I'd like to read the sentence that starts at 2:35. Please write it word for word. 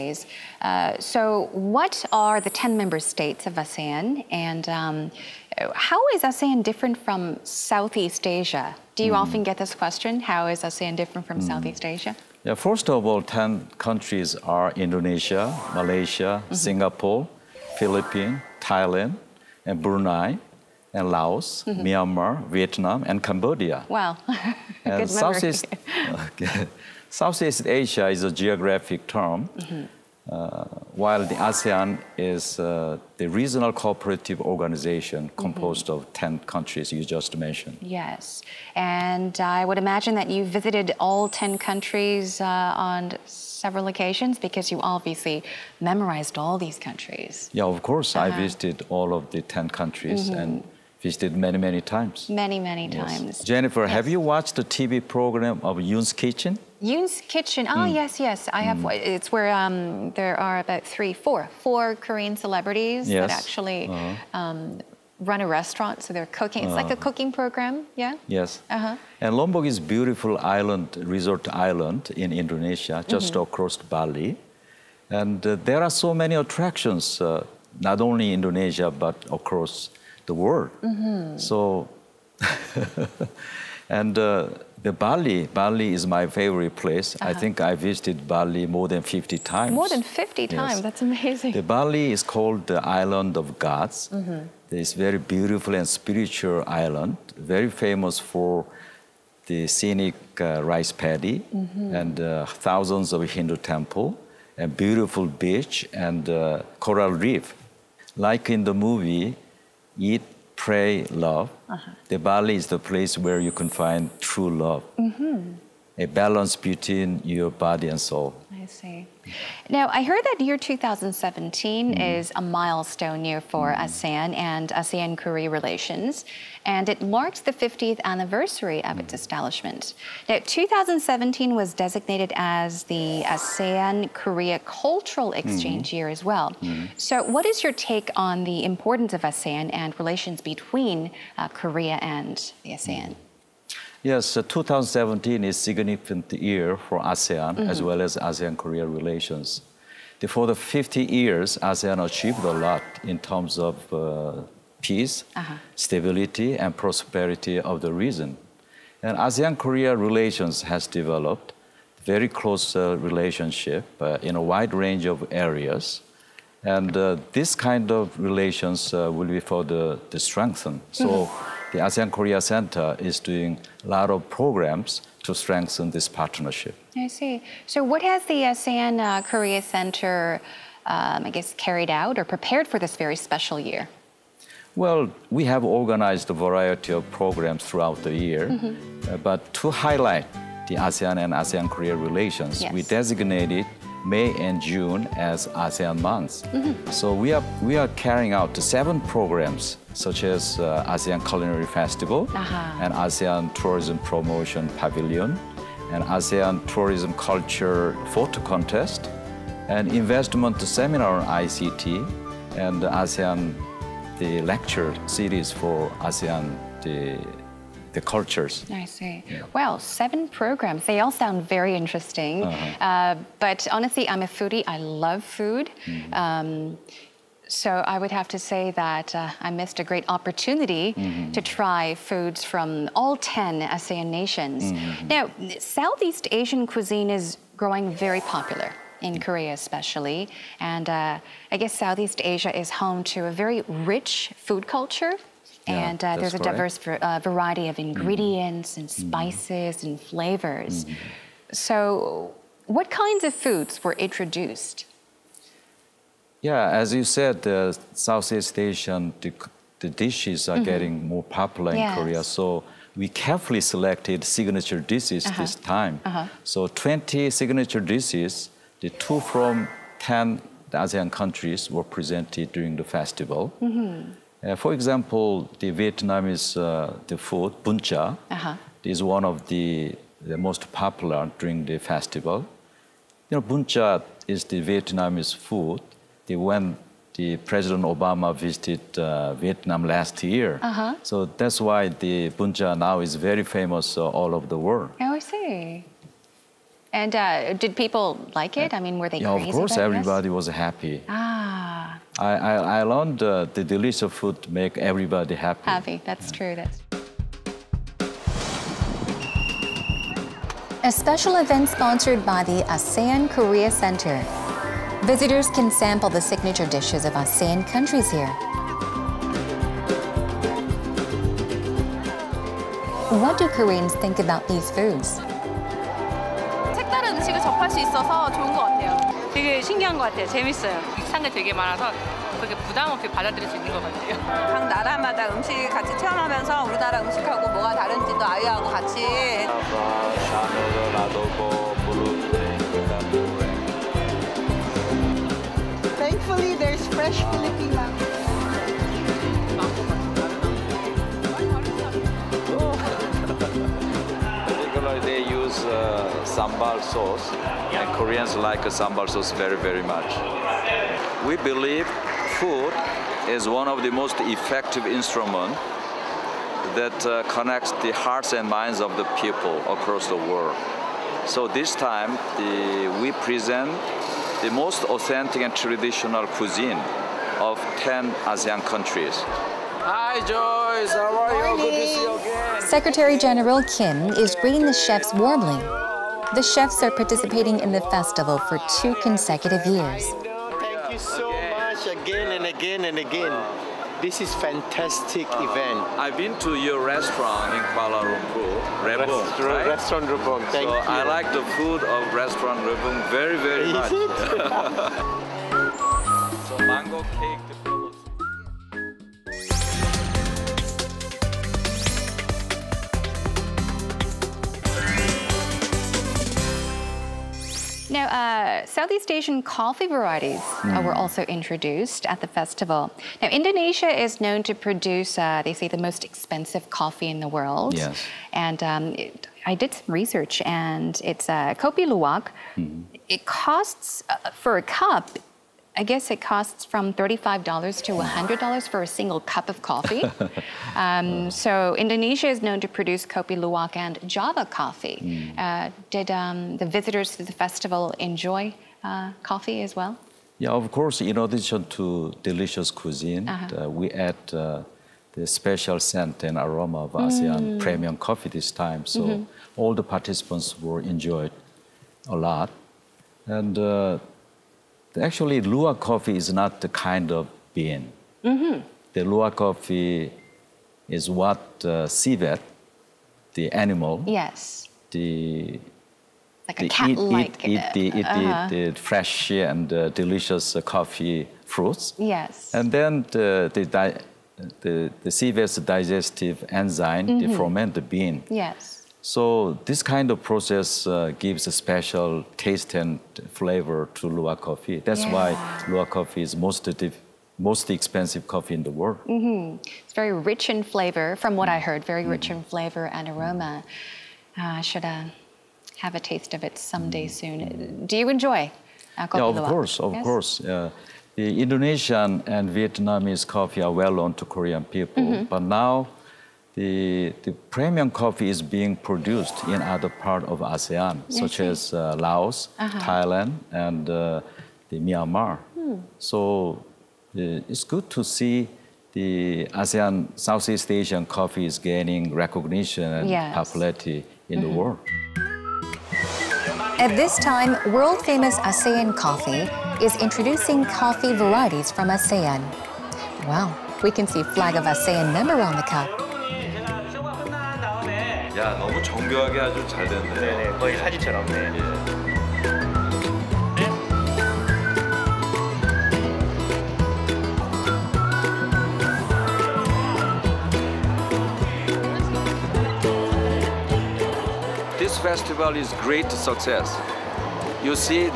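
stability, and prosperity of the region.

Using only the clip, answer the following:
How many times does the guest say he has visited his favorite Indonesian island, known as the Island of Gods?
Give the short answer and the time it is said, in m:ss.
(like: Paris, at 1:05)
more than 50, at 1:28.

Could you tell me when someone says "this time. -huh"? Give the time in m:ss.
4:25.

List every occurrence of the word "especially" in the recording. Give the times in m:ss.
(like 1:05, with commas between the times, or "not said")
3:59.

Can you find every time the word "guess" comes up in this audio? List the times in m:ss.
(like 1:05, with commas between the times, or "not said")
3:01, 4:01, 7:15.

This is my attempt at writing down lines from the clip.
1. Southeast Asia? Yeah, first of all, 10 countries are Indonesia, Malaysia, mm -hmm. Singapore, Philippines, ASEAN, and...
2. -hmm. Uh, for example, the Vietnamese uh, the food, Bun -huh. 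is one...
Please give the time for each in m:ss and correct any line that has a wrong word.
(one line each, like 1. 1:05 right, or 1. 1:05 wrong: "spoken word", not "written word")
1. 0:11 wrong: "Thailand", not "ASEAN"
2. 4:33 right.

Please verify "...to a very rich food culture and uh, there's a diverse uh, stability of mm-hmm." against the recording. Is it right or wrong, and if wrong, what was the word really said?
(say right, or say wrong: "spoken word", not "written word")
wrong: "variety", not "stability".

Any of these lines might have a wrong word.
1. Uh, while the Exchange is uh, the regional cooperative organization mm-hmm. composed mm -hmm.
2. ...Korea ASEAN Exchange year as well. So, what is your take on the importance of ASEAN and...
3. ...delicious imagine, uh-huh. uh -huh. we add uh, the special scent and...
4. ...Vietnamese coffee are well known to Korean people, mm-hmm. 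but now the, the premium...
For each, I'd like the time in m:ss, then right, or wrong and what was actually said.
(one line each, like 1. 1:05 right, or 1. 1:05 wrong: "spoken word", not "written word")
1. 0:30 wrong: "ASEAN", not "Exchange"
2. 2:14 wrong: "Cultural", not "ASEAN"
3. 7:32 wrong: "cuisine", not "imagine"
4. 8:32 right.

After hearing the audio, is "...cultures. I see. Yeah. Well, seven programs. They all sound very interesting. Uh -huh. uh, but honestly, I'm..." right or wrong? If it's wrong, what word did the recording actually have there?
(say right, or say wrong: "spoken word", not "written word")
right.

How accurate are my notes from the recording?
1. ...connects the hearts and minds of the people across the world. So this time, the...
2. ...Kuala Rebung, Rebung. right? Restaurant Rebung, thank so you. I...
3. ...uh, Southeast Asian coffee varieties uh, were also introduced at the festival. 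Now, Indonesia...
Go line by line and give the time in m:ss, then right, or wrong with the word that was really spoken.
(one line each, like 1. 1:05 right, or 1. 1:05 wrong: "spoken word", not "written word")
1. 6:07 right
2. 6:37 wrong: "Lumpur", not "Rebung"
3. 6:58 right.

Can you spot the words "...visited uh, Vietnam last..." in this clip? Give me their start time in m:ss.
4:48.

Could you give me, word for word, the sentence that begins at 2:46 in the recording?
And uh, this kind of relations will be further strengthened.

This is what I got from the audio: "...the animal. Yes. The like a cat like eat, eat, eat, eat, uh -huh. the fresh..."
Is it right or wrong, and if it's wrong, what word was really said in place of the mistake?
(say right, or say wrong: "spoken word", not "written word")
right.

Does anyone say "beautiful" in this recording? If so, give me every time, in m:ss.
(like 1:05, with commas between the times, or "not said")
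1:09, 1:35, 1:44.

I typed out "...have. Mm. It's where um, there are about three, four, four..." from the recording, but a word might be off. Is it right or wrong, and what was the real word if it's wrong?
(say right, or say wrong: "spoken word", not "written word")
right.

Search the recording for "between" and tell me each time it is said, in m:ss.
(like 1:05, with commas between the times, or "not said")
1:56, 2:20.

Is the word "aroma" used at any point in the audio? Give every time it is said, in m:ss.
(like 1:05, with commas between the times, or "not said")
7:36, 8:23.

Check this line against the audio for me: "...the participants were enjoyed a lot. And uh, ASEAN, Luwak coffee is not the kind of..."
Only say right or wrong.
wrong.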